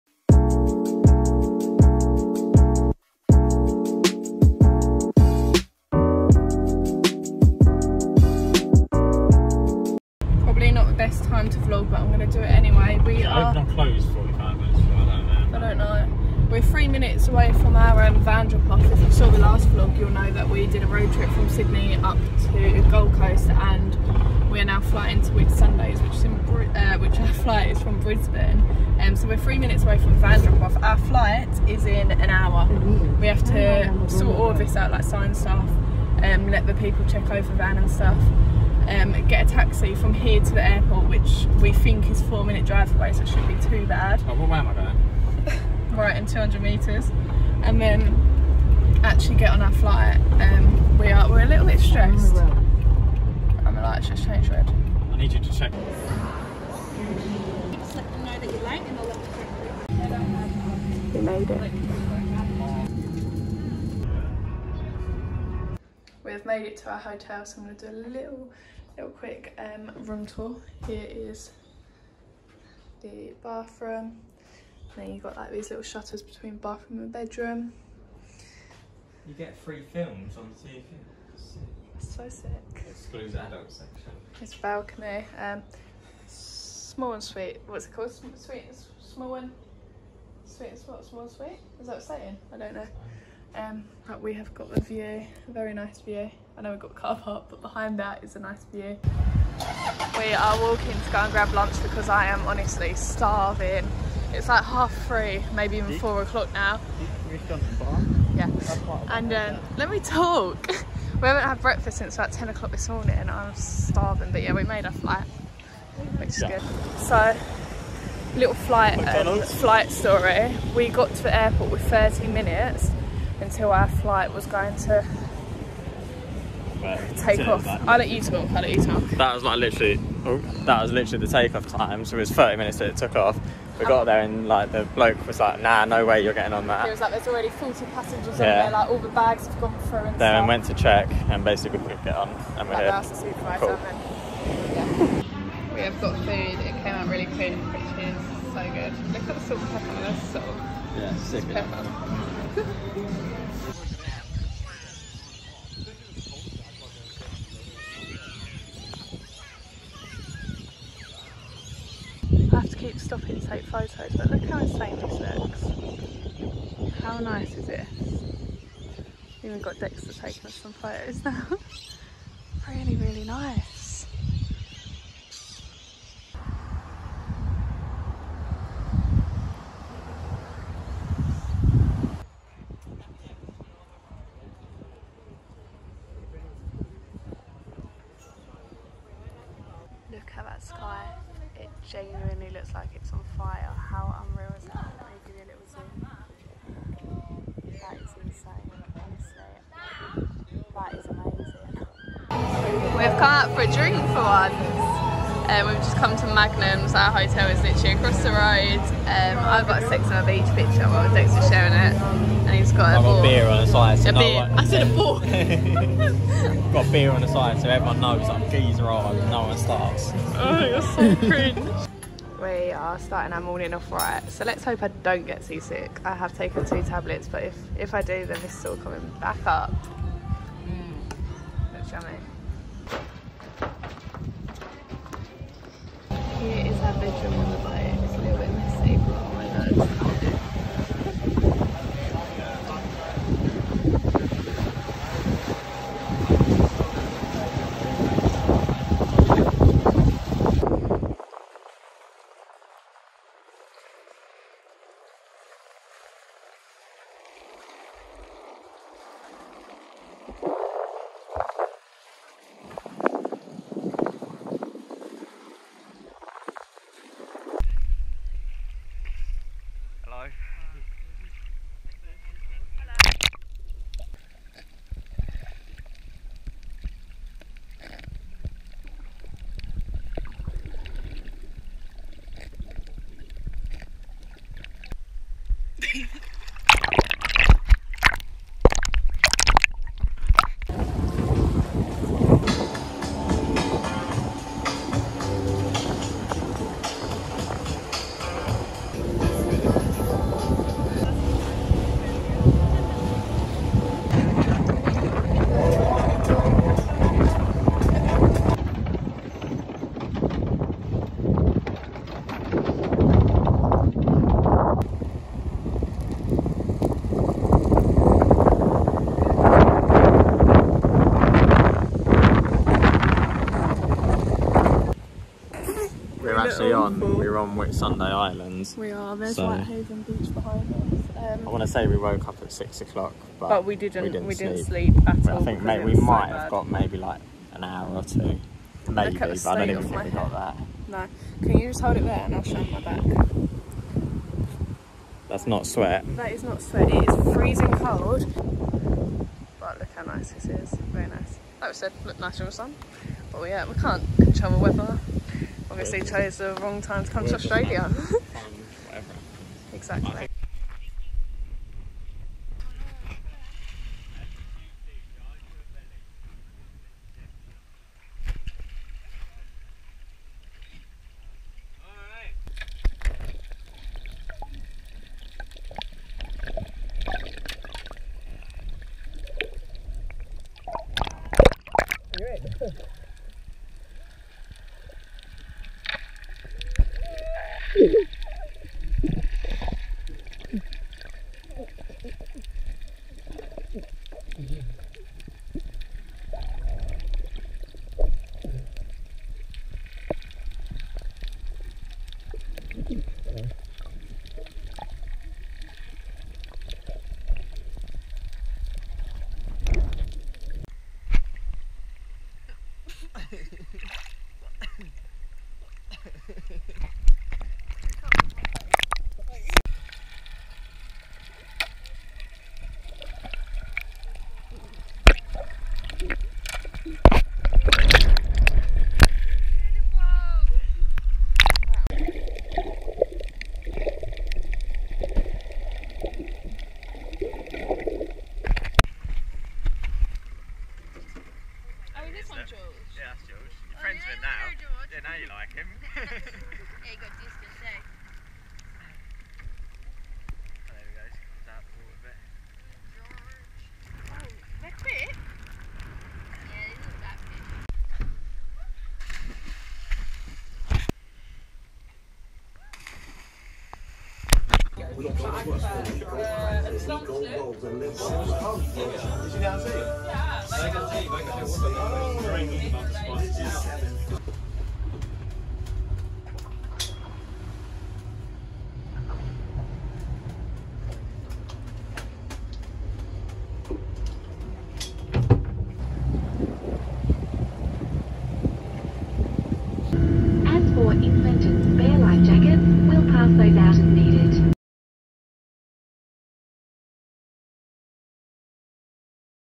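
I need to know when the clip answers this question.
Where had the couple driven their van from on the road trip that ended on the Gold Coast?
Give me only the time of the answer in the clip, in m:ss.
0:21.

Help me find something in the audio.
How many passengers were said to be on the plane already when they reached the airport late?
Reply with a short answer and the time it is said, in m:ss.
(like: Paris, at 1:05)
40, at 2:17.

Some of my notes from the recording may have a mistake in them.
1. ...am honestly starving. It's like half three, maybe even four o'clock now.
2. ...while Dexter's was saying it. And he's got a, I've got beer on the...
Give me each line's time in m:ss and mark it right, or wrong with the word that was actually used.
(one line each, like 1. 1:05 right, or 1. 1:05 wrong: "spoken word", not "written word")
1. 1:42 right
2. 3:30 wrong: "sharing", not "saying".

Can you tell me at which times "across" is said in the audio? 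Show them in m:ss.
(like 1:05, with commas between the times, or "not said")
3:27.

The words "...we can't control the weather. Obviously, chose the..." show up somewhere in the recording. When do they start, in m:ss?
5:53.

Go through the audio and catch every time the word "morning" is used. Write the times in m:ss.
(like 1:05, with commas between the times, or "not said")
1:52, 3:43.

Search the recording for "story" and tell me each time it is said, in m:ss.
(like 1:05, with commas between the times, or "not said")
1:59.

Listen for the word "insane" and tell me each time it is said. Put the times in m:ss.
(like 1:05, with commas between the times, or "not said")
2:44, 3:18.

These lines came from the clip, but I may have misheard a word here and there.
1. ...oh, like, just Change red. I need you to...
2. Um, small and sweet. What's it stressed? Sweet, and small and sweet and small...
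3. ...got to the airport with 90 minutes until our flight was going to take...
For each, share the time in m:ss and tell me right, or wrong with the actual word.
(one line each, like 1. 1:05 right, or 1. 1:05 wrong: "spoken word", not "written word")
1. 0:53 right
2. 1:25 wrong: "called", not "stressed"
3. 2:00 wrong: "30", not "90".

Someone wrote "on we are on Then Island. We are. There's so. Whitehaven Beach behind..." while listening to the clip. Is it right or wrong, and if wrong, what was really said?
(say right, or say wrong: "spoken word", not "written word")
wrong: "Whitsunday", not "Then".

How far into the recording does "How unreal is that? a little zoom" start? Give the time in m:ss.
3:13.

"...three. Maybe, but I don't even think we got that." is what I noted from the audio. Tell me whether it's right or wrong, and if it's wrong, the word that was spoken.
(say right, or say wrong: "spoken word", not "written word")
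wrong: "two", not "three".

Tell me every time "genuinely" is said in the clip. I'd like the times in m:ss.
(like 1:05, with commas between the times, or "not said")
3:11.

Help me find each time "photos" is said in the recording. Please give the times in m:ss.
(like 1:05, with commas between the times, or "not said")
2:43, 2:50.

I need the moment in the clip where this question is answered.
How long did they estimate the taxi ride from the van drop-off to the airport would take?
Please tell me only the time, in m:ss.
0:42.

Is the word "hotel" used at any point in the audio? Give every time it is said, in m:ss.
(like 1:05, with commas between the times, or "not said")
1:06, 3:27.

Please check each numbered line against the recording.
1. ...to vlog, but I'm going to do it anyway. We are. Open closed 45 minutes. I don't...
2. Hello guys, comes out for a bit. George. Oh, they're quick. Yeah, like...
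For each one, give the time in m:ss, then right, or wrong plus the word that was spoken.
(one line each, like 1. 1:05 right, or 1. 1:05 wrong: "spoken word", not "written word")
1. 0:11 right
2. 7:30 right.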